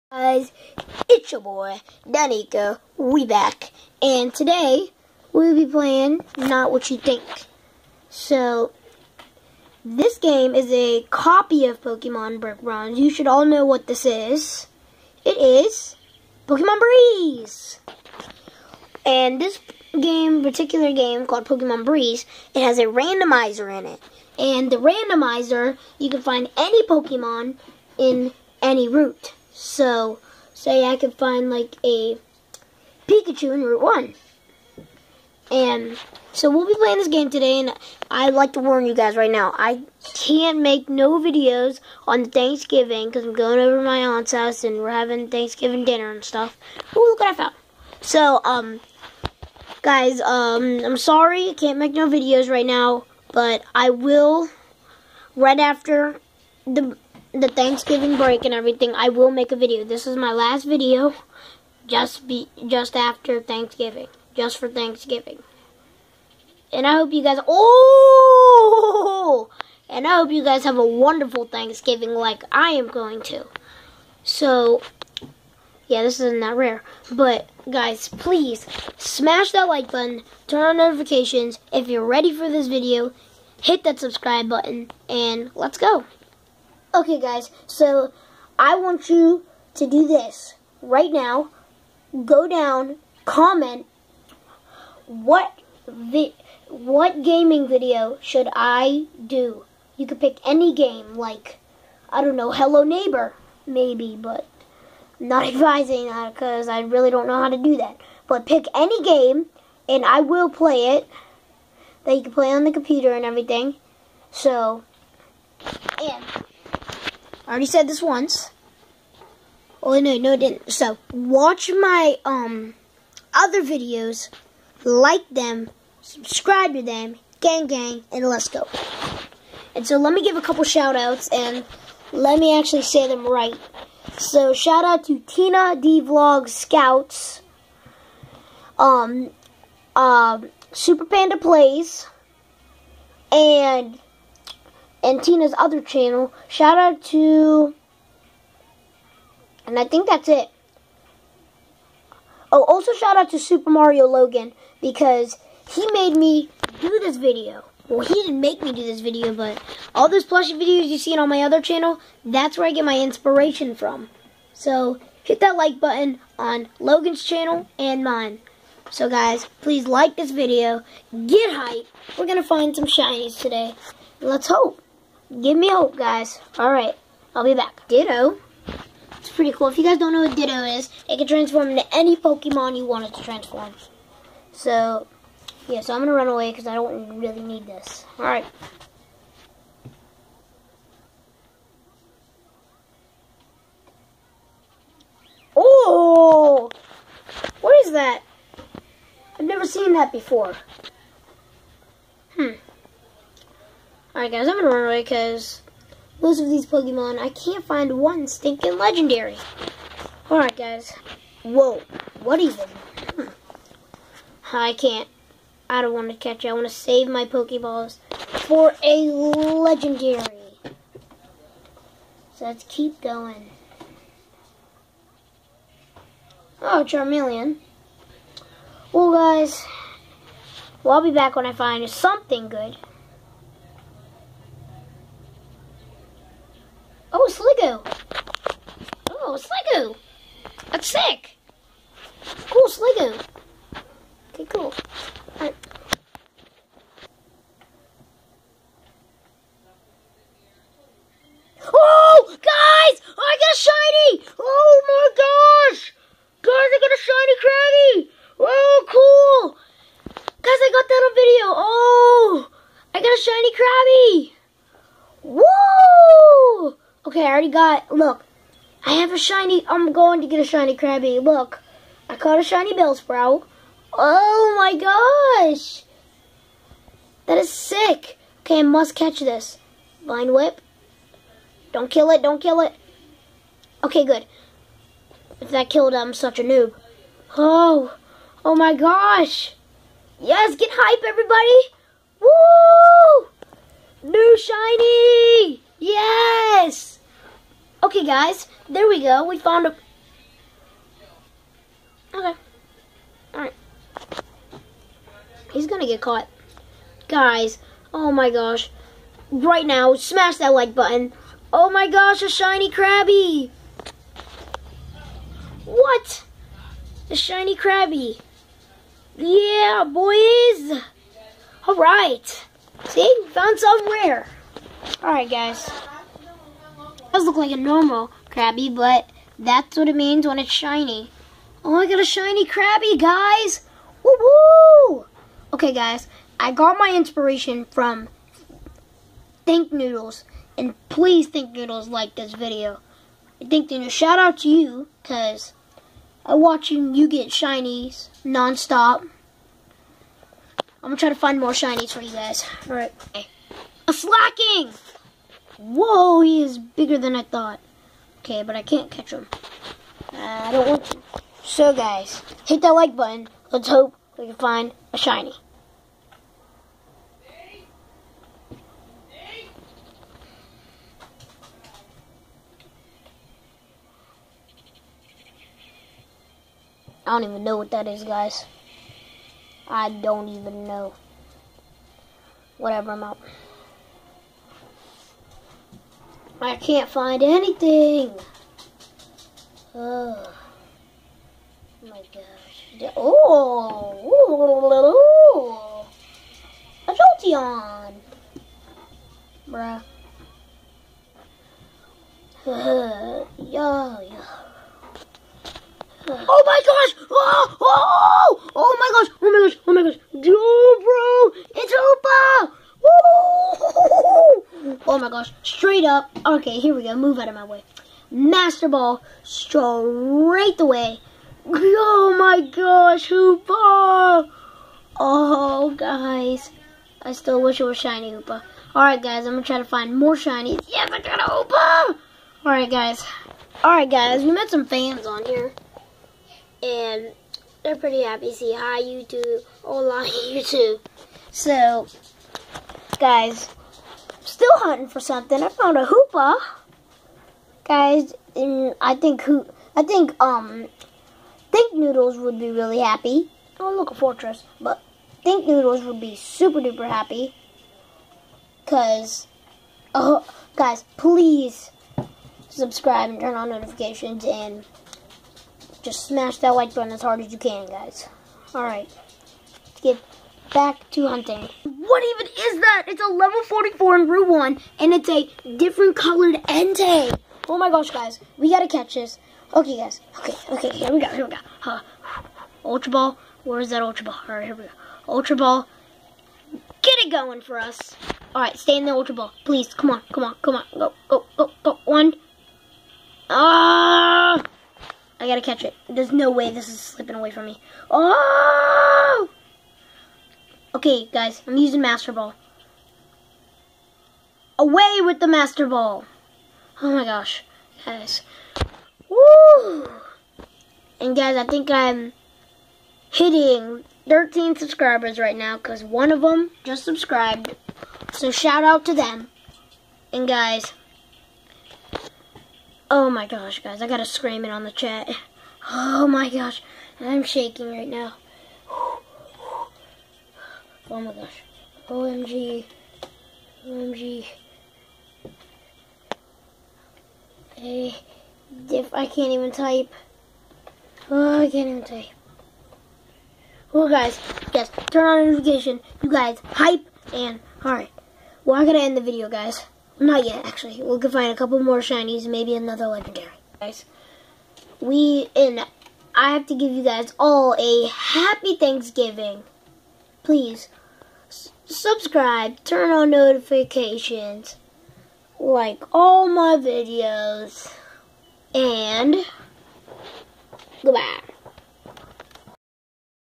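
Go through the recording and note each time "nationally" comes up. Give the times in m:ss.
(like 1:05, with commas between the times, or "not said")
not said.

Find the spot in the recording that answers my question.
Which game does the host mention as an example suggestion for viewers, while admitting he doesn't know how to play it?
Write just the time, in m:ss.
1:42.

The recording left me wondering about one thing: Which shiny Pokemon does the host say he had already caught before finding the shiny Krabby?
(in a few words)
Bellsprout.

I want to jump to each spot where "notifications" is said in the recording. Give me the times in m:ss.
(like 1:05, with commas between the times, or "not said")
1:20, 7:43, 9:05, 9:23.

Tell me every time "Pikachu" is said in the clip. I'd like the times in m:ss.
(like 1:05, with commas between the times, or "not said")
0:33.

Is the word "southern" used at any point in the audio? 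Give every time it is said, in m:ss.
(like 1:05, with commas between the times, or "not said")
not said.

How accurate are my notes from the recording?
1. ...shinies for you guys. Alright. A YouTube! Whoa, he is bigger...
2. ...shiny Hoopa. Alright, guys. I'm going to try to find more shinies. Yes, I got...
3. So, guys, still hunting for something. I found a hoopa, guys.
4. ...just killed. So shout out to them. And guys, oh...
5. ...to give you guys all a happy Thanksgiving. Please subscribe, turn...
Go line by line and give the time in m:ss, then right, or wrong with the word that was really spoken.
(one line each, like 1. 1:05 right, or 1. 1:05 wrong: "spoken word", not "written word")
1. 5:51 wrong: "Slaking", not "YouTube"
2. 7:07 right
3. 7:21 right
4. 8:36 wrong: "subscribed", not "killed"
5. 9:16 right.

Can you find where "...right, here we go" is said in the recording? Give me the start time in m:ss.
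8:04.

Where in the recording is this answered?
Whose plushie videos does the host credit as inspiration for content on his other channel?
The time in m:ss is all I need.
2:33.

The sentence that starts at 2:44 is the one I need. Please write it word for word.
So hit that like button on Logan's channel and mine.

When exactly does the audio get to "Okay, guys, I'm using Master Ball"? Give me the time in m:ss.
8:20.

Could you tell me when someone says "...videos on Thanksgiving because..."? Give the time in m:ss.
0:41.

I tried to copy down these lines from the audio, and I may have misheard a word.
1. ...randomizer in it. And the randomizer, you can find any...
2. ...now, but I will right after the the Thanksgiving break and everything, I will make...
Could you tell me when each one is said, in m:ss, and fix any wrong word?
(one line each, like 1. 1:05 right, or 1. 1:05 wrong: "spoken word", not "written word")
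1. 0:22 right
2. 0:52 right.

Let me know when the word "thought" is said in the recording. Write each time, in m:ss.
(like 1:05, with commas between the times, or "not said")
5:57.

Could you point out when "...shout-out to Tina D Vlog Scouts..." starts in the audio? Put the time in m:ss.
2:14.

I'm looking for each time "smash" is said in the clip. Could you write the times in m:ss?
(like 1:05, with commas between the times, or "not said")
1:18, 5:09, 7:46.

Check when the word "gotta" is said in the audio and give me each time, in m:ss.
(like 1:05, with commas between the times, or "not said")
7:58, 8:15, 8:43.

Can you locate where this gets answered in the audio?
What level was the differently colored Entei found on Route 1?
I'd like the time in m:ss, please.
7:53.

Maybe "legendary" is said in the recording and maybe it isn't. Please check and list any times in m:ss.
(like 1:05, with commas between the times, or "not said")
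3:28, 3:39, 9:12.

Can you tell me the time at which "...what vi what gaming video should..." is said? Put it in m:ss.
1:35.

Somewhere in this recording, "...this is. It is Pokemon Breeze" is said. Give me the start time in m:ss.
0:13.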